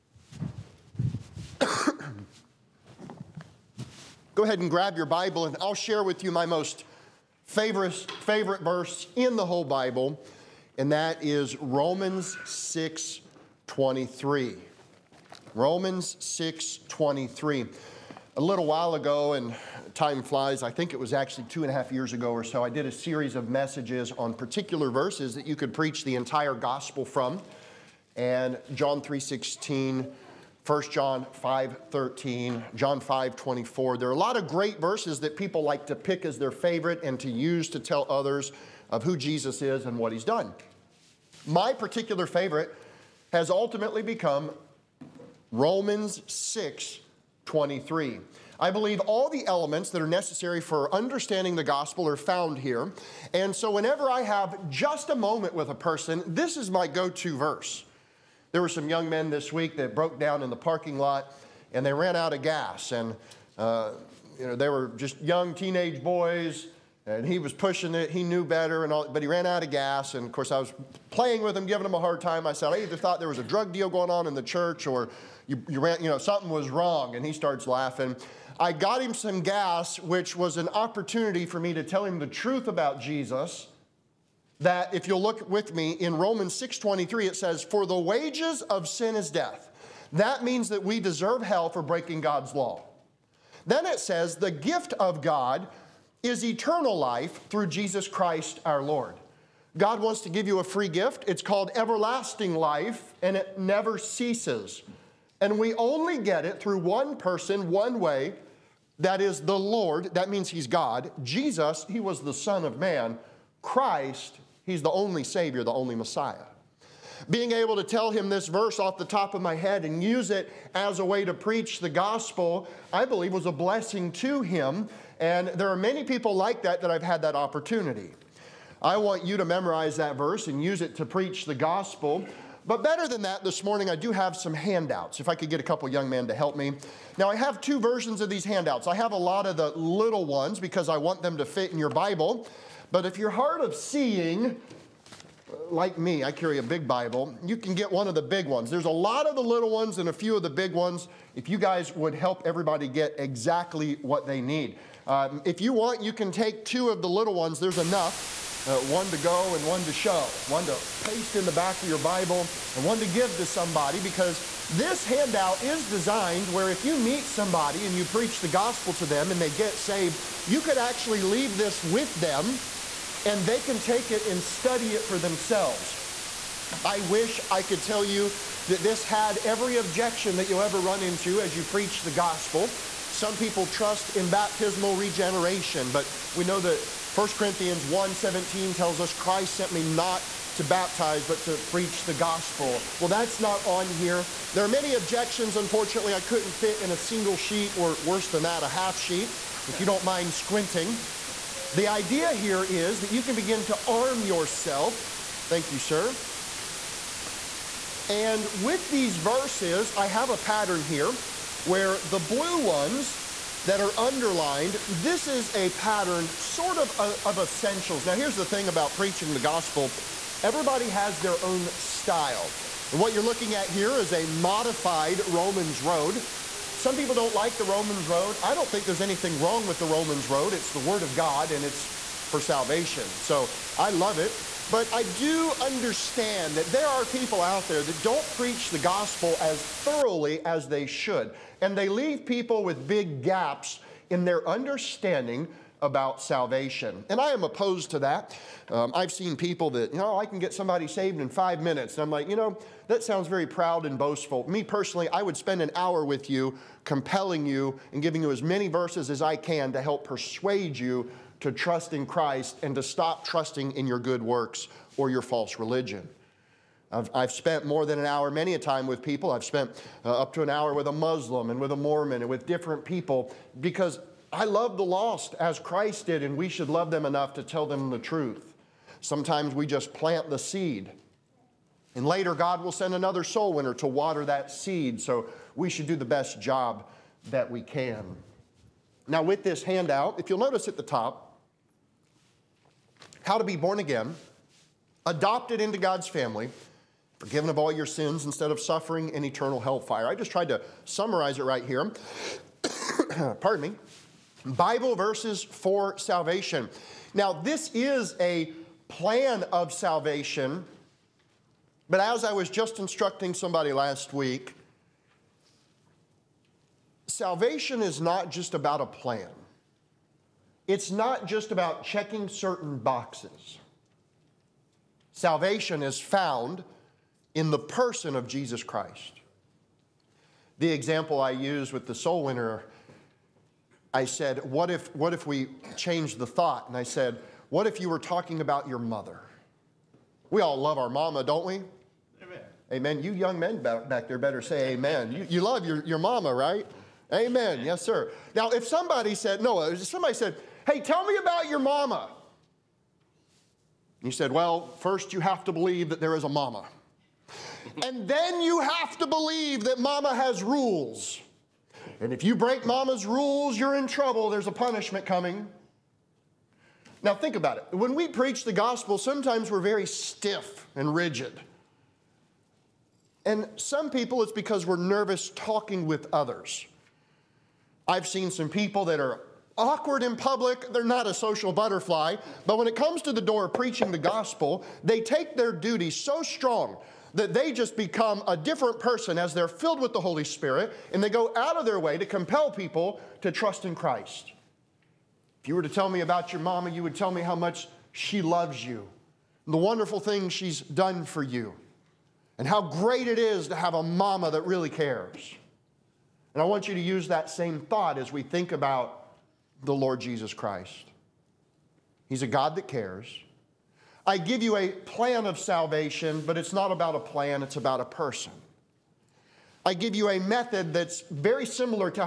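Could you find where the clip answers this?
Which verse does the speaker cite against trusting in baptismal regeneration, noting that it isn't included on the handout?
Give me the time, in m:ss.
3:07.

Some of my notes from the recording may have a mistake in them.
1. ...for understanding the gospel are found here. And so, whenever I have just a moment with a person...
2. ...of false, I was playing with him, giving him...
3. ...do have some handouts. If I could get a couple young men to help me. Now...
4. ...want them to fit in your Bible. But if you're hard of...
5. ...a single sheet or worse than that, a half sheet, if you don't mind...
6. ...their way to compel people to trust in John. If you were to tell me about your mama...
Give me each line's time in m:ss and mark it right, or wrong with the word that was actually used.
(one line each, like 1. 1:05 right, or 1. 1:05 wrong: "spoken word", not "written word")
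1. 0:50 right
2. 1:10 wrong: "course", not "false"
3. 2:13 right
4. 2:20 right
5. 3:16 right
6. 6:31 wrong: "Christ", not "John".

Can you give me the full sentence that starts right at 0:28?
And John 3.16, 1 John 5.13, John 5.24.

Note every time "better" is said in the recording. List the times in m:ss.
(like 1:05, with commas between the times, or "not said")
1:08, 2:12, 5:44.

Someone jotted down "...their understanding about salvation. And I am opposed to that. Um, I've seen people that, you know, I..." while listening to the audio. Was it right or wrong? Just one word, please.
right.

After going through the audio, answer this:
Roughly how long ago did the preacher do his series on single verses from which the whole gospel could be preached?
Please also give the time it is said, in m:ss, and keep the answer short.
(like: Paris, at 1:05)
two and a half years, at 0:21.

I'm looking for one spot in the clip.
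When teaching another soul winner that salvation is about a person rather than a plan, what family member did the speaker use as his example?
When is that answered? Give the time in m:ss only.
5:38.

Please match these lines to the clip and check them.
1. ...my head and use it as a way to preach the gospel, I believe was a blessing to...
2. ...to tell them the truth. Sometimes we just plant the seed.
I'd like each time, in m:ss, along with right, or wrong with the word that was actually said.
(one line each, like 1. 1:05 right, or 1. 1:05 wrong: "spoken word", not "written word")
1. 1:59 right
2. 4:37 right.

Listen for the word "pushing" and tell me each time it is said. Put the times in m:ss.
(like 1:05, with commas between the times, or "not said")
1:07.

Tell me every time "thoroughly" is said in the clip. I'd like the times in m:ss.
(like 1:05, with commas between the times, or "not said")
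3:59.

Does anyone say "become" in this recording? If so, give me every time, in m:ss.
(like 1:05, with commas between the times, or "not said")
0:44, 6:27.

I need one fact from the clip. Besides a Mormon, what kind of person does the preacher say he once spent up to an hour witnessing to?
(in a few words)
a Muslim.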